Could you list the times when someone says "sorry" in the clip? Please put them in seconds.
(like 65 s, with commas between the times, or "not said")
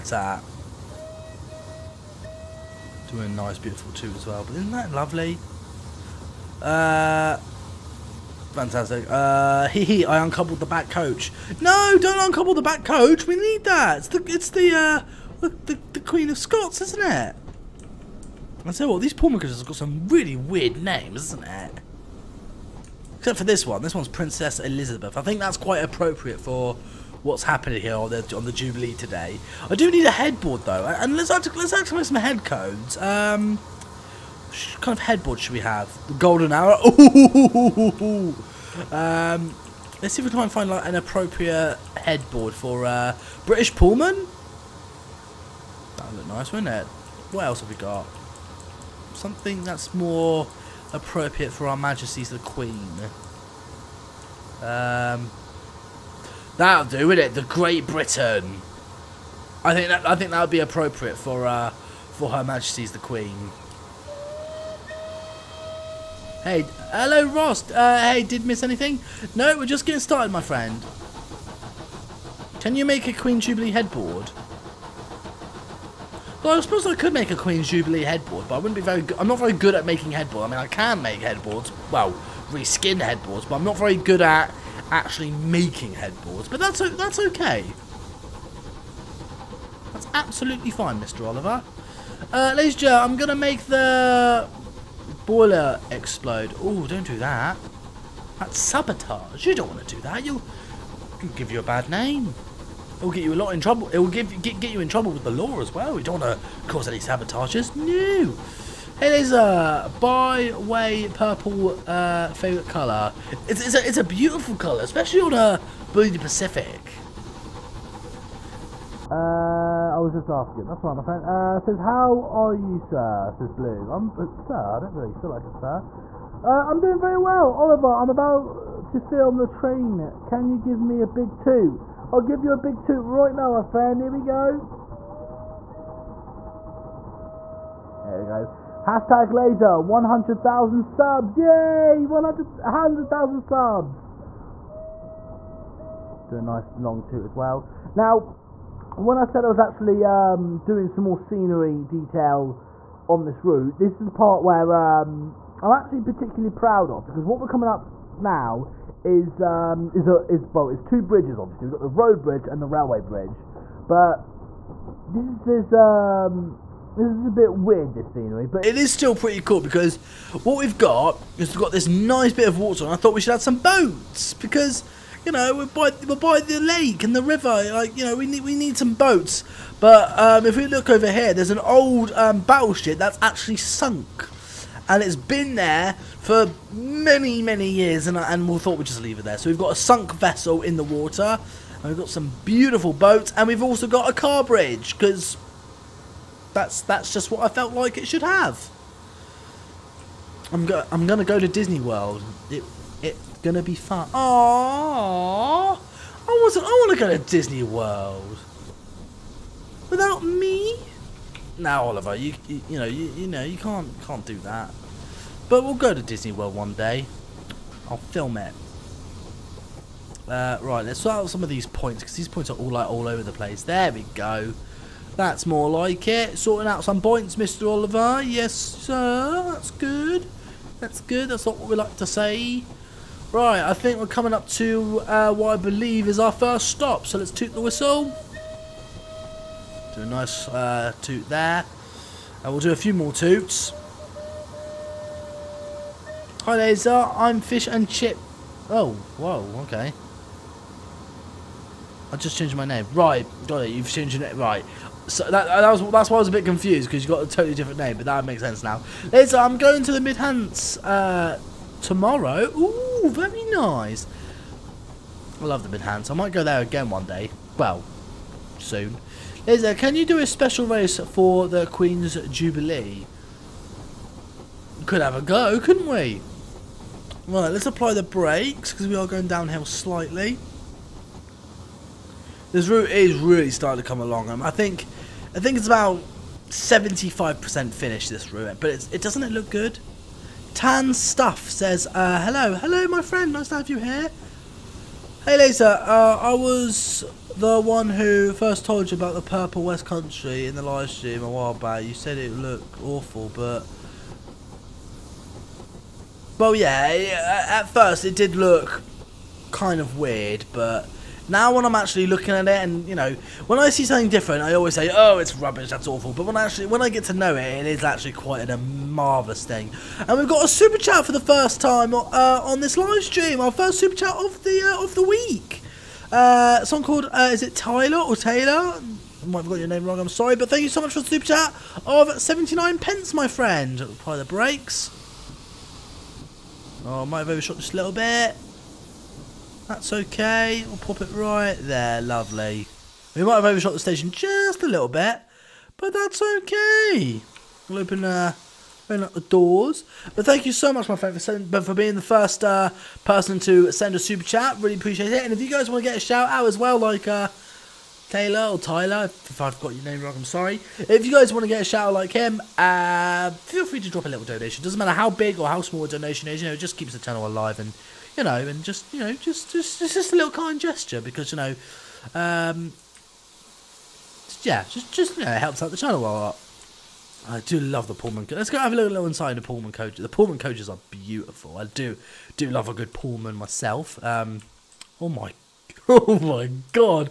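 330 s, 360 s.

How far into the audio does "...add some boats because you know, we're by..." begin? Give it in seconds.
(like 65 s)
173 s.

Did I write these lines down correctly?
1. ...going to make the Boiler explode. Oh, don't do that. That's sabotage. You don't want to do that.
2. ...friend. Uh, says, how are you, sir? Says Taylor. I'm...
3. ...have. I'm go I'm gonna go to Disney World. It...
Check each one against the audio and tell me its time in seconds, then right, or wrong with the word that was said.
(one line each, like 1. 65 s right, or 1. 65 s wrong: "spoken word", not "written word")
1. 93 s right
2. 121 s wrong: "Blue", not "Taylor"
3. 198 s right.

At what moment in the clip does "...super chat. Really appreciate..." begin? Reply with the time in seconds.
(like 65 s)
353 s.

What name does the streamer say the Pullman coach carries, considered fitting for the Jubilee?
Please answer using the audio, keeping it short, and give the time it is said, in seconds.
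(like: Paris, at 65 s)
Princess Elizabeth, at 24 s.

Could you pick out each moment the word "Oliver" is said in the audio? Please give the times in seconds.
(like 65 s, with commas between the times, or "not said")
91 s, 127 s, 211 s, 227 s.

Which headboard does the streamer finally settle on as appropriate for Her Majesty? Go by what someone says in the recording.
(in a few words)
The Great Britain.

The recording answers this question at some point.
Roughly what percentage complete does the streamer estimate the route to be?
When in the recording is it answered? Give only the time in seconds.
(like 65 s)
286 s.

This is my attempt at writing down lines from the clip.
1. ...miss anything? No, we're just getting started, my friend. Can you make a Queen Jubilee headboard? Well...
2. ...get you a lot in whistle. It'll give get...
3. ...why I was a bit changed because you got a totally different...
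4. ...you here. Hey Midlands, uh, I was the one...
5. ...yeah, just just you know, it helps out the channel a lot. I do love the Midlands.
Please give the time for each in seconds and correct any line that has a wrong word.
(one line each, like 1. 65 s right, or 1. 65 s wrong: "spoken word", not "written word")
1. 68 s right
2. 103 s wrong: "trouble", not "whistle"
3. 256 s wrong: "confused", not "changed"
4. 293 s wrong: "Laser", not "Midlands"
5. 374 s wrong: "Pullman", not "Midlands".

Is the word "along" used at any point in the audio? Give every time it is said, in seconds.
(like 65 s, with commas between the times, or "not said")
284 s.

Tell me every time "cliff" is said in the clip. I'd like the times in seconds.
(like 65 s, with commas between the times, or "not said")
not said.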